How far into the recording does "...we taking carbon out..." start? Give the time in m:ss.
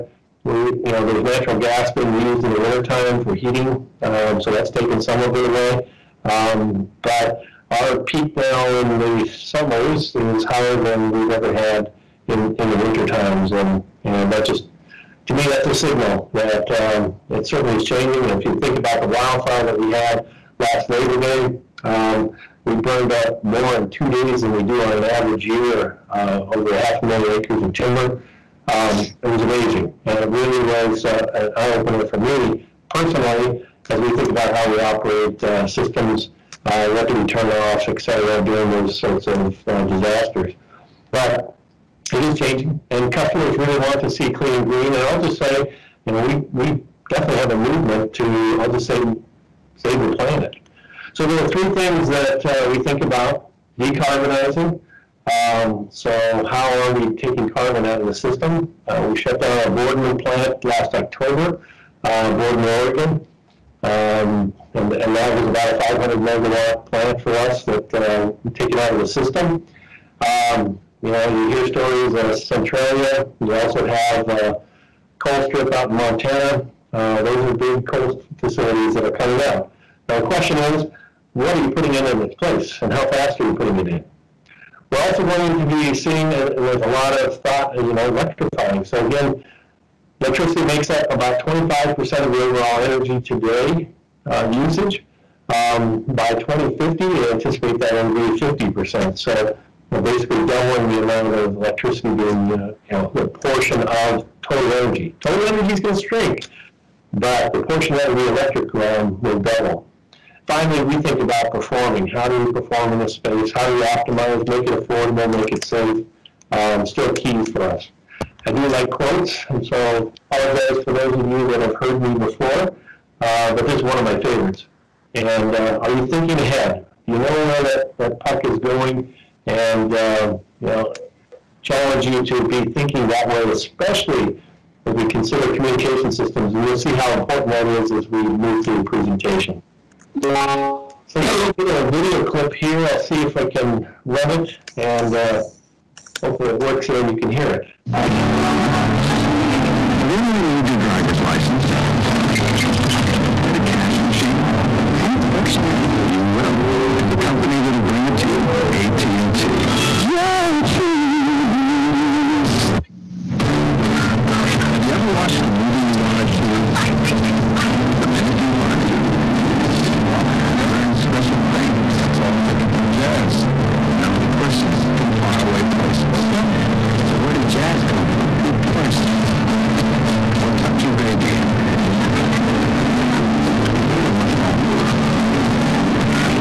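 0:56.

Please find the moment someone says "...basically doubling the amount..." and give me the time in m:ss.
1:39.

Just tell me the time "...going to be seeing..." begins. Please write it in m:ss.
1:25.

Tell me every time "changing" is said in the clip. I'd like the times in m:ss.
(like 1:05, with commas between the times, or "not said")
0:17, 0:42.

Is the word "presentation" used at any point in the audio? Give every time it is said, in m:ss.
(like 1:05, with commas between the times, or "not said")
2:18.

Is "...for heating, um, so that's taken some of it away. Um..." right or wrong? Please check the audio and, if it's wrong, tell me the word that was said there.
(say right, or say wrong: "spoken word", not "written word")
right.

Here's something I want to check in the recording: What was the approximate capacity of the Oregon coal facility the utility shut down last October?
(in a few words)
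500 megawatt.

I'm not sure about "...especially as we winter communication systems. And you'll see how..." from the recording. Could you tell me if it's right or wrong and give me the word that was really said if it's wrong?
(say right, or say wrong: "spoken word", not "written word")
wrong: "consider", not "winter".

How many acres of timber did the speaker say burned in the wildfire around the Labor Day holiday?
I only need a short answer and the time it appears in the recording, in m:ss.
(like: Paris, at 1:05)
over half a million acres, at 0:26.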